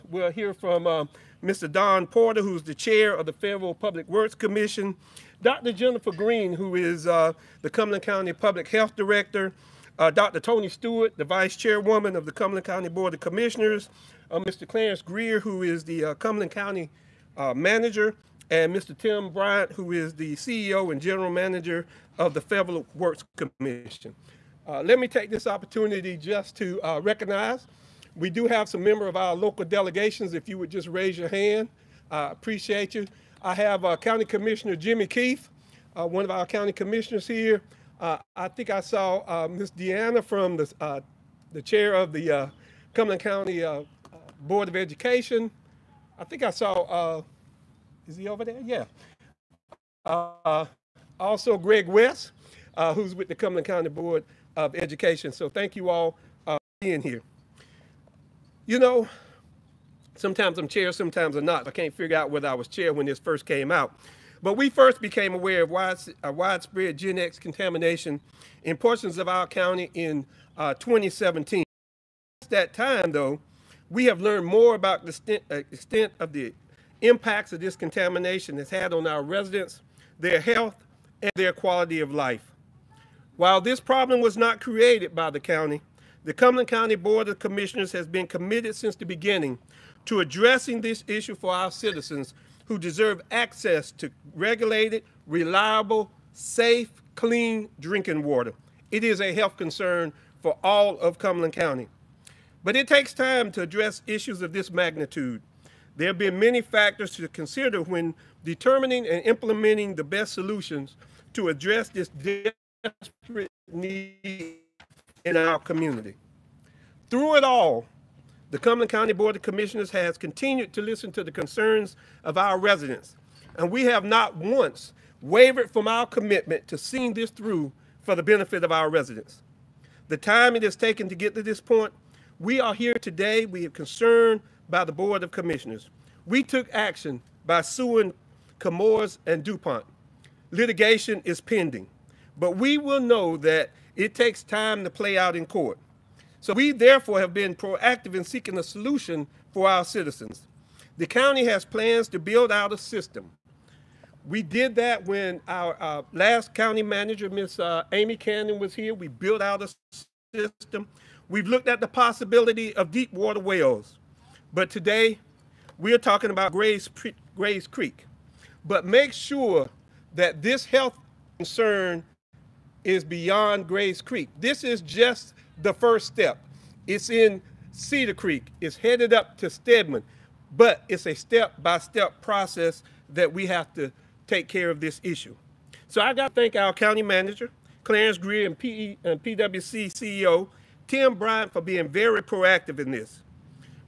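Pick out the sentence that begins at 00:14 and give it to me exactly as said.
Clarence Grier, who is the Cumberland County Manager, and Mr.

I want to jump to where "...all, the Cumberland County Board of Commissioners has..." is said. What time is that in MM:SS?
01:57.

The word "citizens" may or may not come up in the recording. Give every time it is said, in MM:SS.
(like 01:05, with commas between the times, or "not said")
01:31, 02:29.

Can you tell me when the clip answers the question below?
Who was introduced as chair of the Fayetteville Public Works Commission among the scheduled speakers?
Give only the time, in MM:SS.
00:01.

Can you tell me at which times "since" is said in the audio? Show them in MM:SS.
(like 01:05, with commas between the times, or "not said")
01:12, 01:28.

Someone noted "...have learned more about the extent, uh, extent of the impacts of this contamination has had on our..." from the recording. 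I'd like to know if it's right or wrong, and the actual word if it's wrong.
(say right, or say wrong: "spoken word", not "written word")
right.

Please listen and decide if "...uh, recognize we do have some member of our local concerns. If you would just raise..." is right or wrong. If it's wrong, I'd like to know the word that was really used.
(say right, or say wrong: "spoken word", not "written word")
wrong: "delegations", not "concerns".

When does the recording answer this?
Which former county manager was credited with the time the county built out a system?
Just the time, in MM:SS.
02:37.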